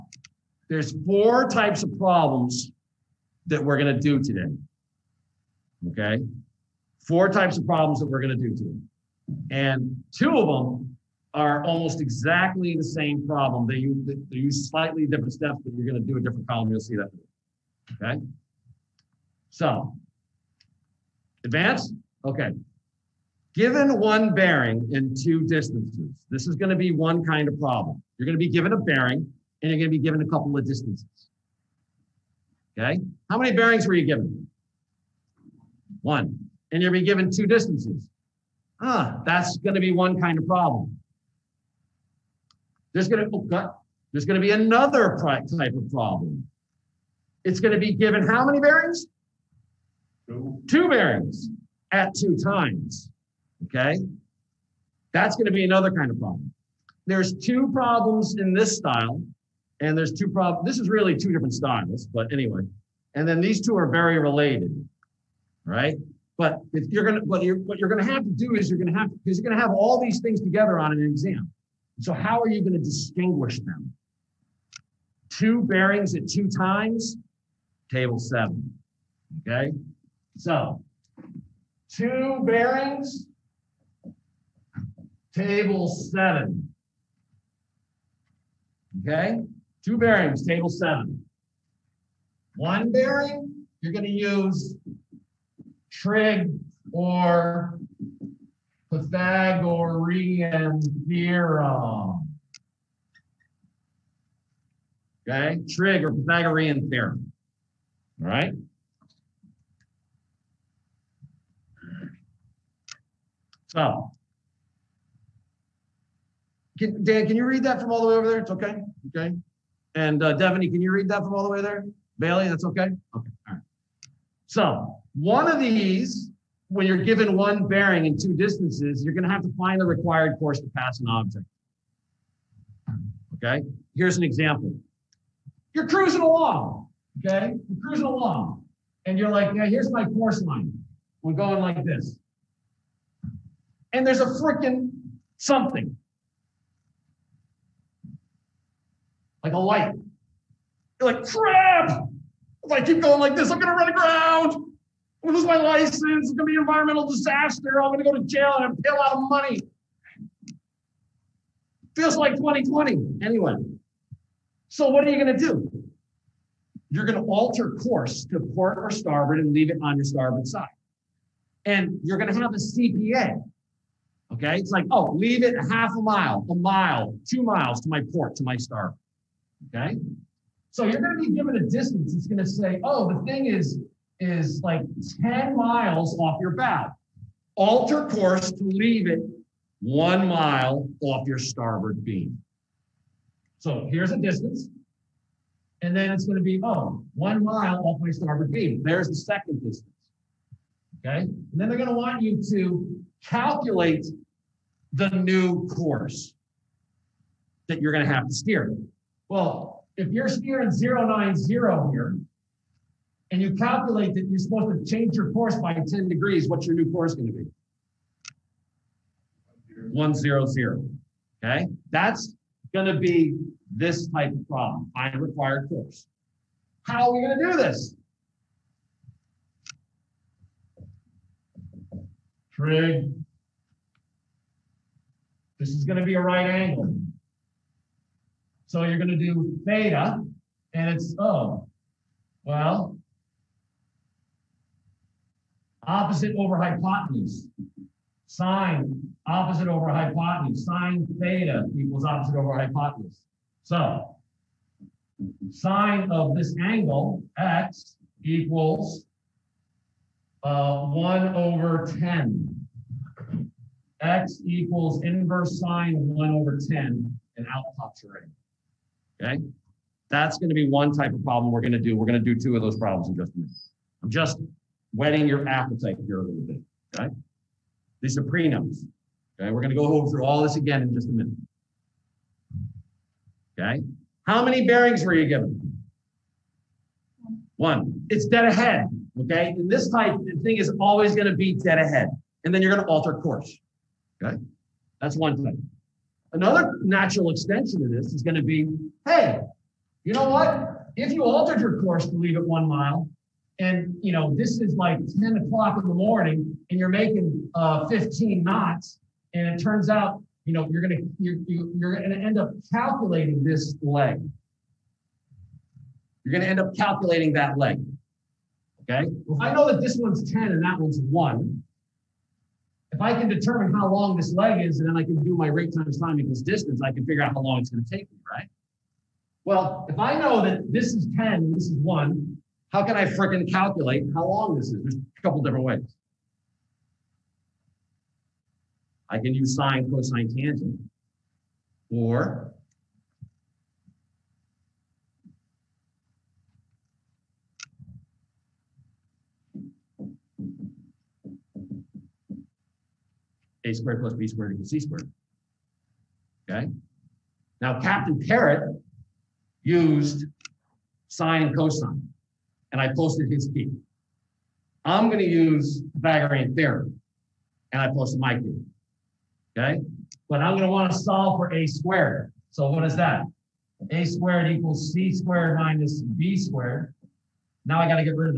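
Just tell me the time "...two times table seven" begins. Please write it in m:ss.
1:16.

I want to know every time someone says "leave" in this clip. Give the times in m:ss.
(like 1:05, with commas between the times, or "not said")
2:49, 2:55, 3:08, 5:02.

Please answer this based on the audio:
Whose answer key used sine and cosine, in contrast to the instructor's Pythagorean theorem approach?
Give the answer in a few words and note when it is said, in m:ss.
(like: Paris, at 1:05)
Captain Parrot, at 5:57.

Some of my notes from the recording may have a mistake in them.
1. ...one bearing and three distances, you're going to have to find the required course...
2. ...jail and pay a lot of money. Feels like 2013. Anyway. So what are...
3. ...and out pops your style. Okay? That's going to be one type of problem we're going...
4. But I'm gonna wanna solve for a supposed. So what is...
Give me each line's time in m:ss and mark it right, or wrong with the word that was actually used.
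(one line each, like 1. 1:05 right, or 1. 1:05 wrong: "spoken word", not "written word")
1. 2:07 wrong: "two", not "three"
2. 2:38 wrong: "2020", not "2013"
3. 4:27 wrong: "angle", not "style"
4. 6:10 wrong: "squared", not "supposed".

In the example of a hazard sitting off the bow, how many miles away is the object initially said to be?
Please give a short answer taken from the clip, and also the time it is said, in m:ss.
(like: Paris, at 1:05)
10 miles, at 3:05.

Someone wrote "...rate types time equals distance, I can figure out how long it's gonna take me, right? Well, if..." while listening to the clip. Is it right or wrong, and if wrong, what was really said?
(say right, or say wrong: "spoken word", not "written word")
wrong: "times", not "types".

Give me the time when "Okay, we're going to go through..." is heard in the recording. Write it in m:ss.
4:39.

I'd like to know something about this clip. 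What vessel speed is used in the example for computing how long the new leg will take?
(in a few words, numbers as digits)
15 knots.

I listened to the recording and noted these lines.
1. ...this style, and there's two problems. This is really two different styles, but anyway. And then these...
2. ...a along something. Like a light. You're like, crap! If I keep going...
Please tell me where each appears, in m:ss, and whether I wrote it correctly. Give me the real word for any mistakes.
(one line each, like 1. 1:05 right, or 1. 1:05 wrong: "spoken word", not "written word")
1. 0:58 right
2. 2:24 wrong: "freaking", not "along".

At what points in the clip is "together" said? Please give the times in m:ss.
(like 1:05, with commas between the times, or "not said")
1:10.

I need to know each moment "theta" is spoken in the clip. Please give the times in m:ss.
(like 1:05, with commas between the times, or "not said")
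3:59, 4:11.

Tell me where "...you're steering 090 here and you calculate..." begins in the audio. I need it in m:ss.
3:30.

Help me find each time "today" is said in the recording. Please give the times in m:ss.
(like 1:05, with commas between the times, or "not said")
0:04, 0:08.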